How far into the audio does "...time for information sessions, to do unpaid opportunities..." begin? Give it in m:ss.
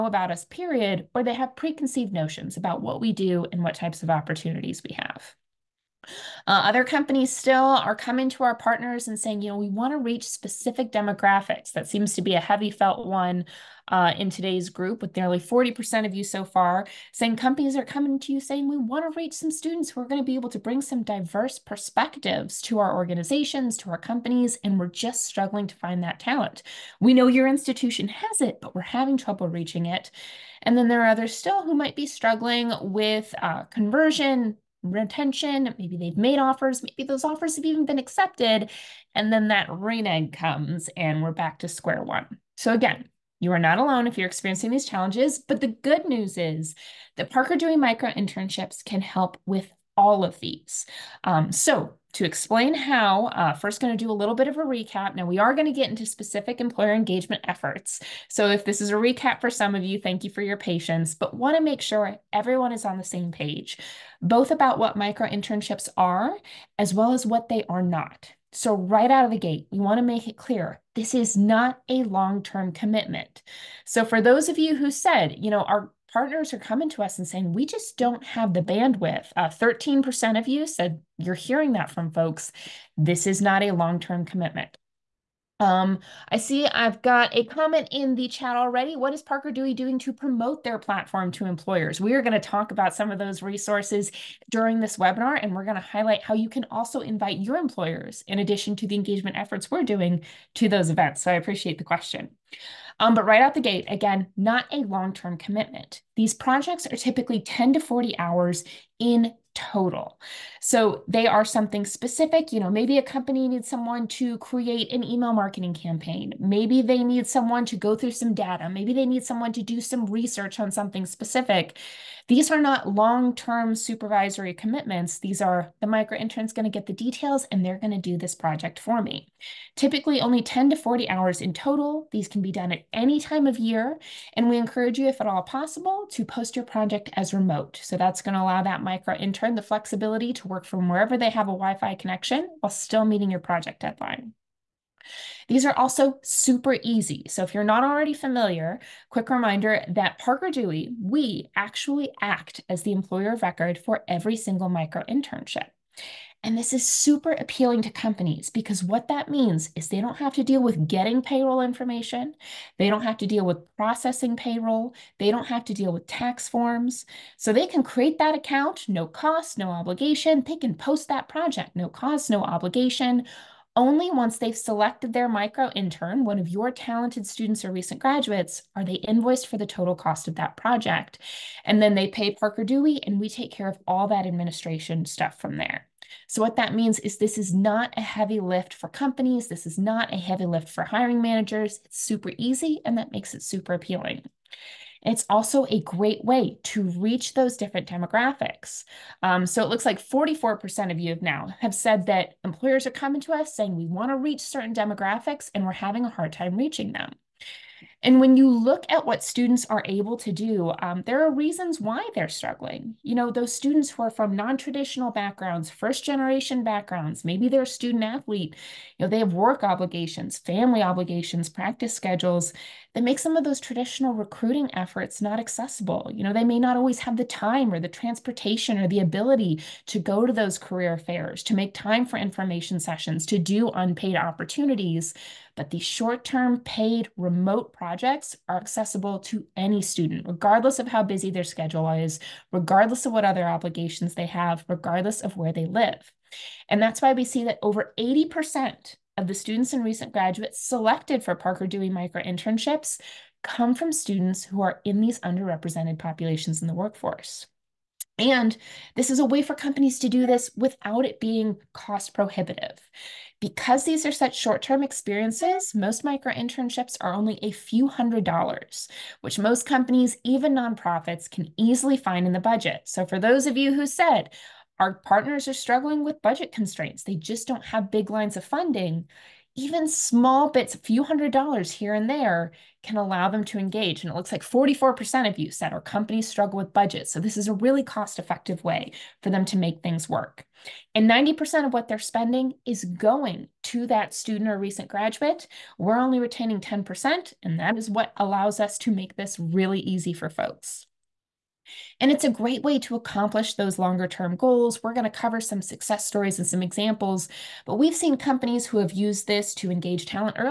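3:51.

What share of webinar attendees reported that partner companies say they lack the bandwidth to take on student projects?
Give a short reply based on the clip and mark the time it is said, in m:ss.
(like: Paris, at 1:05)
13%, at 1:19.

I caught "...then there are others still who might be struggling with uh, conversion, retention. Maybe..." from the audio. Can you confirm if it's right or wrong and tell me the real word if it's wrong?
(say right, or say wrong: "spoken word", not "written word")
right.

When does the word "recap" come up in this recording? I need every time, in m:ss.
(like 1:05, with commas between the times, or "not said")
0:54, 0:58.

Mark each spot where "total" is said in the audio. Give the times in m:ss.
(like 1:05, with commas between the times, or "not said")
1:49, 2:11, 2:59.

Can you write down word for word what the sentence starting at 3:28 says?
And when you look at what students are able to do, um, there are reasons why they're struggling.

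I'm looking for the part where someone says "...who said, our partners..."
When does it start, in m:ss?
4:33.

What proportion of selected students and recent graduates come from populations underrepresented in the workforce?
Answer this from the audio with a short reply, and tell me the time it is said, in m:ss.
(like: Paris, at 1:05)
over 80%, at 4:07.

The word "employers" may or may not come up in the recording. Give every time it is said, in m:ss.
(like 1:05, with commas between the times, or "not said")
0:56, 1:31, 1:37, 2:32, 3:22.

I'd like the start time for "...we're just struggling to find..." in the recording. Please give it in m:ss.
0:24.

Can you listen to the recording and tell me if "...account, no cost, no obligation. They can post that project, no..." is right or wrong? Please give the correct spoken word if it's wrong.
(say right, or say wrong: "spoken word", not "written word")
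right.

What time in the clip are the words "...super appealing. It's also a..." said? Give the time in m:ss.
3:13.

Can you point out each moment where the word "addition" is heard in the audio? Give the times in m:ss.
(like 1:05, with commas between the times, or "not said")
1:38.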